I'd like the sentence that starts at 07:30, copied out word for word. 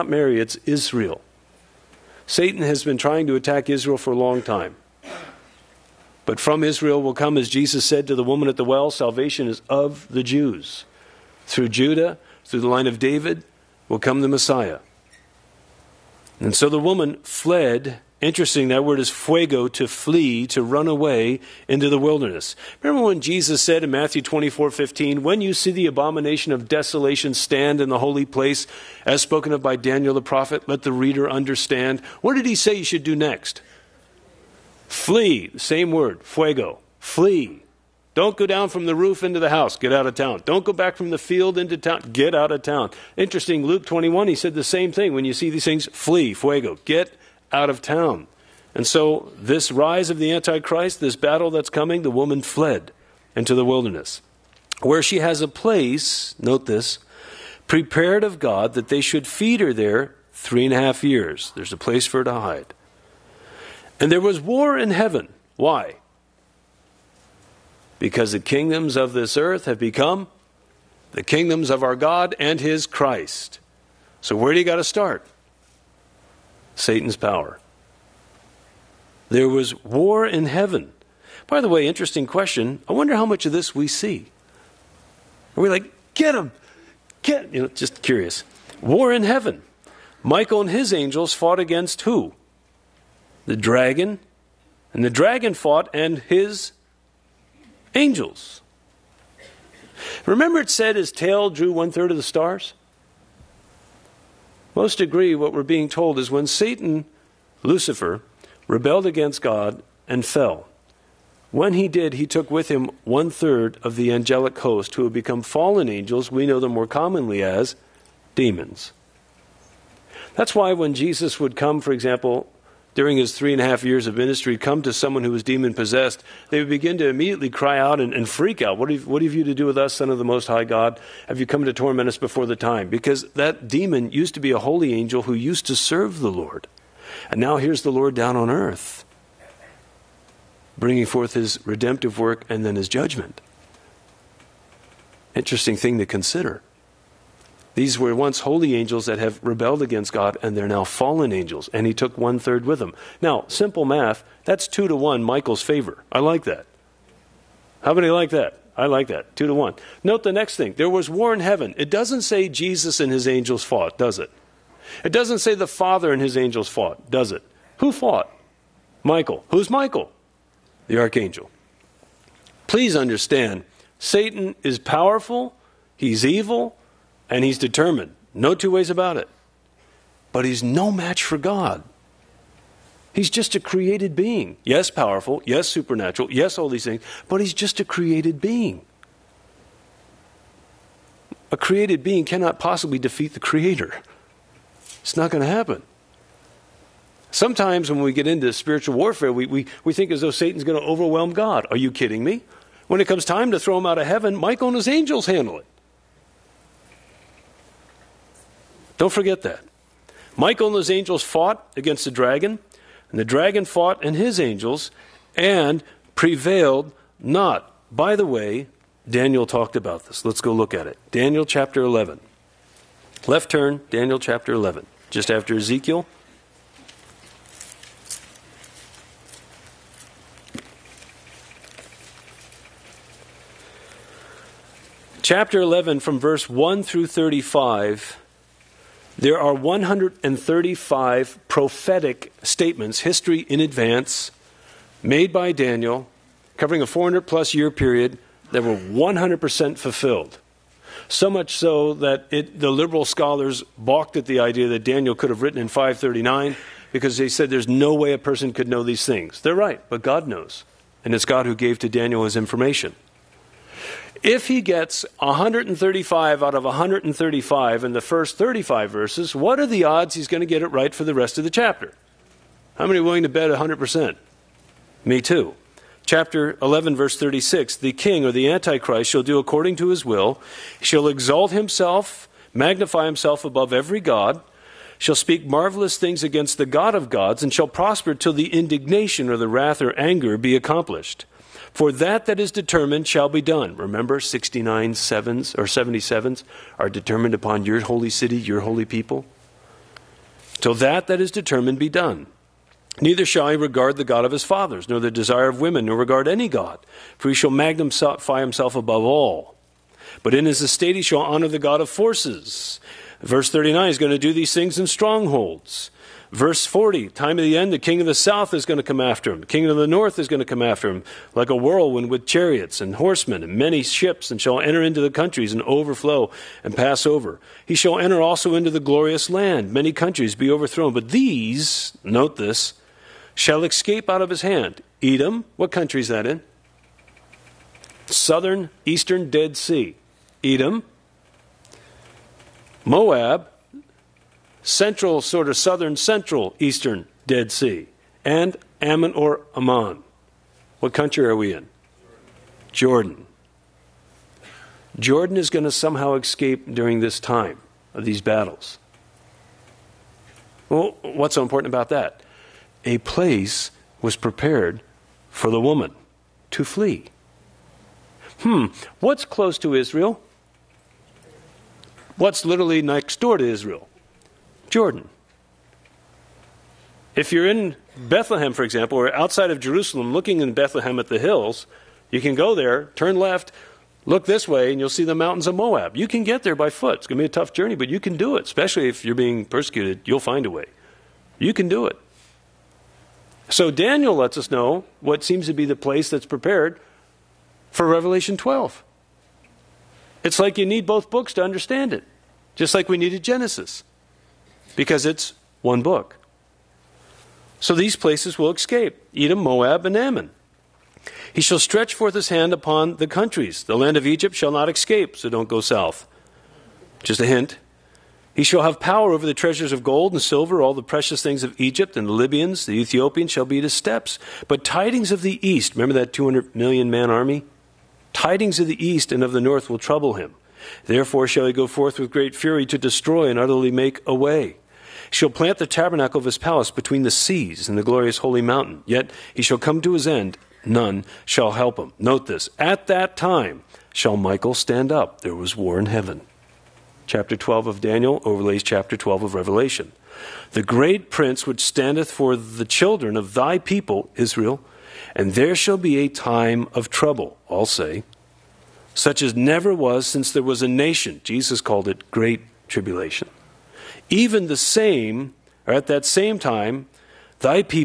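The great prince which standeth for the children of thy people, Israel, and there shall be a time of trouble.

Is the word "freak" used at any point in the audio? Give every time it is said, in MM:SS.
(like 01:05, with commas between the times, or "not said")
02:08.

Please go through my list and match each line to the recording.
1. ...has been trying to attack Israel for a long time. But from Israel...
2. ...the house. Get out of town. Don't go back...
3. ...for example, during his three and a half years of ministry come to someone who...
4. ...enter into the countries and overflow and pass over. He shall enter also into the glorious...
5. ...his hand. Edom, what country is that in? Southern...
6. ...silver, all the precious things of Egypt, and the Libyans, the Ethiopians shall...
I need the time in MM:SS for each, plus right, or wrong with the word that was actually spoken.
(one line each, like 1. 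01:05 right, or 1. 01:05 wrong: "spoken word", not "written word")
1. 00:02 right
2. 00:39 right
3. 02:01 right
4. 05:24 right
5. 05:34 right
6. 07:00 right.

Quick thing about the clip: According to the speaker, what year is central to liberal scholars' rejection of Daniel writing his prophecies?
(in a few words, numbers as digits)
539.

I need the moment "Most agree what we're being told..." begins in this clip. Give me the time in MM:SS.
01:44.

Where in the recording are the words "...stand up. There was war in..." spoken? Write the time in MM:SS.
07:24.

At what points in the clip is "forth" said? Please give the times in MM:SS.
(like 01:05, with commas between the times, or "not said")
02:21, 06:51, 07:11.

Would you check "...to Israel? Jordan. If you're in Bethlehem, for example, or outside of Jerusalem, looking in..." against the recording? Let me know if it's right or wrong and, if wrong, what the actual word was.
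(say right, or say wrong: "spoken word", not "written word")
right.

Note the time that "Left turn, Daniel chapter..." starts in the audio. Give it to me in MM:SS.
03:43.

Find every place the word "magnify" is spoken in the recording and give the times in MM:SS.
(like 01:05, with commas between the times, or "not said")
04:42, 05:07.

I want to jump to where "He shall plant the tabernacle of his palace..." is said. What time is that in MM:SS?
07:15.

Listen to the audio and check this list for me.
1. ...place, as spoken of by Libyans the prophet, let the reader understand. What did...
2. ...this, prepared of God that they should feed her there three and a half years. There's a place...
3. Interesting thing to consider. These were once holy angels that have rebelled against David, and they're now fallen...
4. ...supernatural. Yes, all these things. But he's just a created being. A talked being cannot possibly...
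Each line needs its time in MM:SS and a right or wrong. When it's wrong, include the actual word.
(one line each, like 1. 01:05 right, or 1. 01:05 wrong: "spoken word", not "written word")
1. 00:28 wrong: "Daniel", not "Libyans"
2. 00:56 right
3. 02:25 wrong: "God", not "David"
4. 03:05 wrong: "created", not "talked".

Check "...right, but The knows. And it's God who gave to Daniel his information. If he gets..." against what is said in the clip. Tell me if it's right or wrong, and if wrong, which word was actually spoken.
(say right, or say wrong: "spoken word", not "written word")
wrong: "God", not "The".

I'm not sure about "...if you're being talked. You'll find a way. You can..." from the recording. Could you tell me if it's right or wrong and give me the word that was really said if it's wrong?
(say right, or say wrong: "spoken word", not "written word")
wrong: "persecuted", not "talked".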